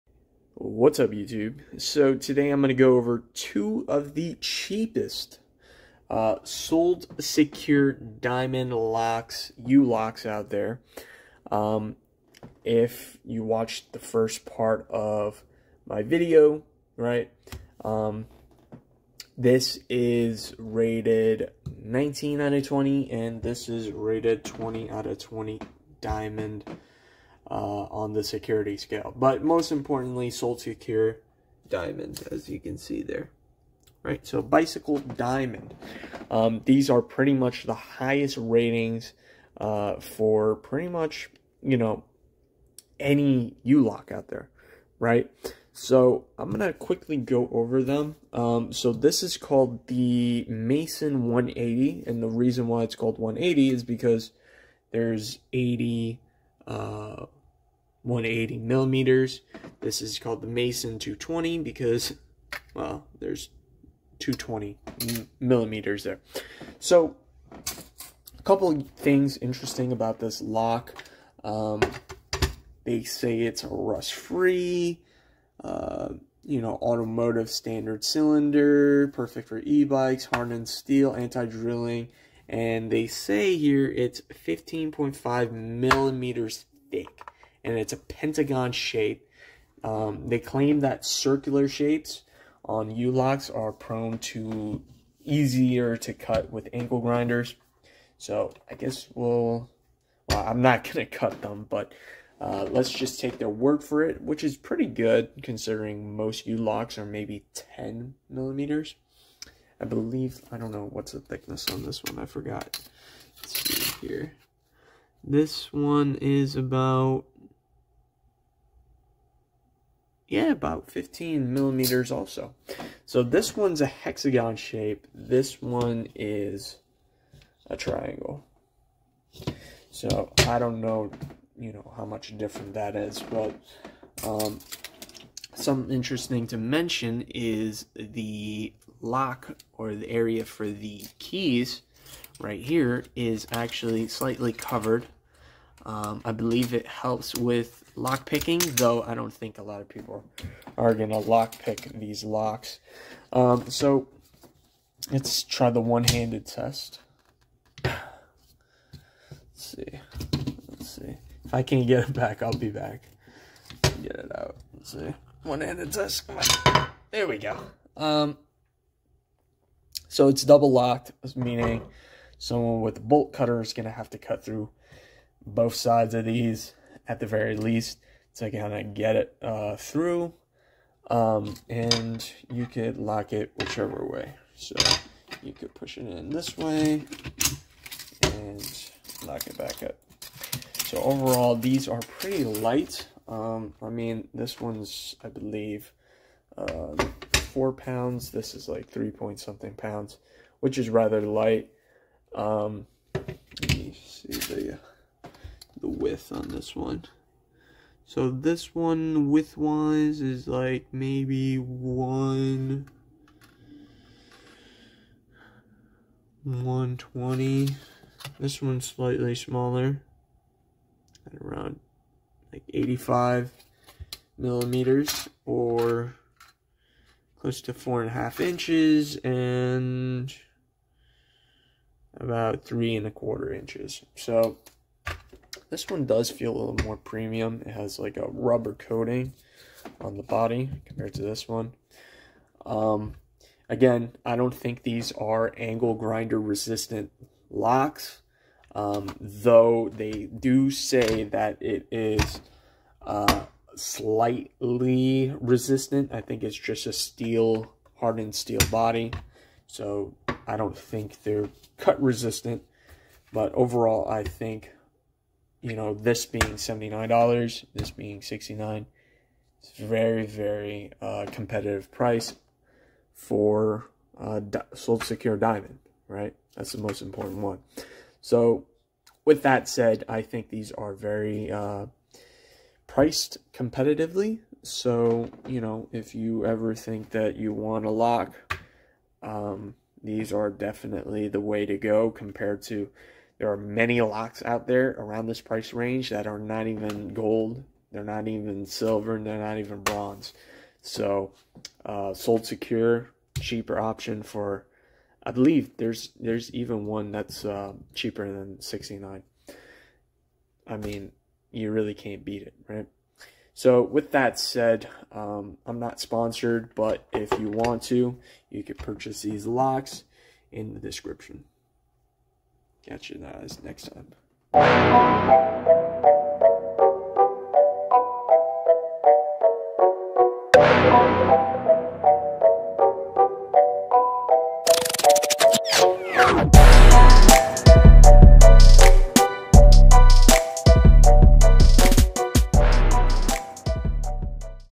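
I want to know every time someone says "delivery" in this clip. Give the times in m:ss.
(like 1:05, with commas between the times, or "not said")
not said.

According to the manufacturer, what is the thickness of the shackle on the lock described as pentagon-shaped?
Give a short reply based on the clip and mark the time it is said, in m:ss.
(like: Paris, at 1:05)
15.5 millimeters, at 1:24.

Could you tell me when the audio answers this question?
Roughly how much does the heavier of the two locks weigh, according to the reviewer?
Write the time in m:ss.
3:17.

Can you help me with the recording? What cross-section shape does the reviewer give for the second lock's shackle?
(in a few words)
Hexagon.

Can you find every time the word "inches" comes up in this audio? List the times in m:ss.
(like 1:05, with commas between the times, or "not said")
3:48, 3:53.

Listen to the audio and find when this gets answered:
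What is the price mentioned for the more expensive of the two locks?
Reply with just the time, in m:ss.
4:26.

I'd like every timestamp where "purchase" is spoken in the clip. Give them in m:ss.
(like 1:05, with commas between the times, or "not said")
5:18.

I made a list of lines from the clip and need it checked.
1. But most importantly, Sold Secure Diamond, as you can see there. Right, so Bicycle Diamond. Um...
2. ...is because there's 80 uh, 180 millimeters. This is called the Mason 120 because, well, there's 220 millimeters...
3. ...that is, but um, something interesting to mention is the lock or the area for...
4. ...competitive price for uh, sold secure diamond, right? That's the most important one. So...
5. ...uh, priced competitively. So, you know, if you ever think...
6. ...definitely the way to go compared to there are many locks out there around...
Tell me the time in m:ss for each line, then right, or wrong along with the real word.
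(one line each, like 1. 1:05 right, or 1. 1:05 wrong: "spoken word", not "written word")
1. 0:29 right
2. 0:53 wrong: "220", not "120"
3. 2:12 right
4. 4:31 right
5. 4:41 right
6. 4:50 right.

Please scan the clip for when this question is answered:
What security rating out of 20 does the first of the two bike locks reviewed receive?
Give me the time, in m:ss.
0:21.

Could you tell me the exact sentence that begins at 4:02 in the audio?
Um, again, I don't think these are angle grinder resistant locks, um, though they do say that it is uh, slightly resistant.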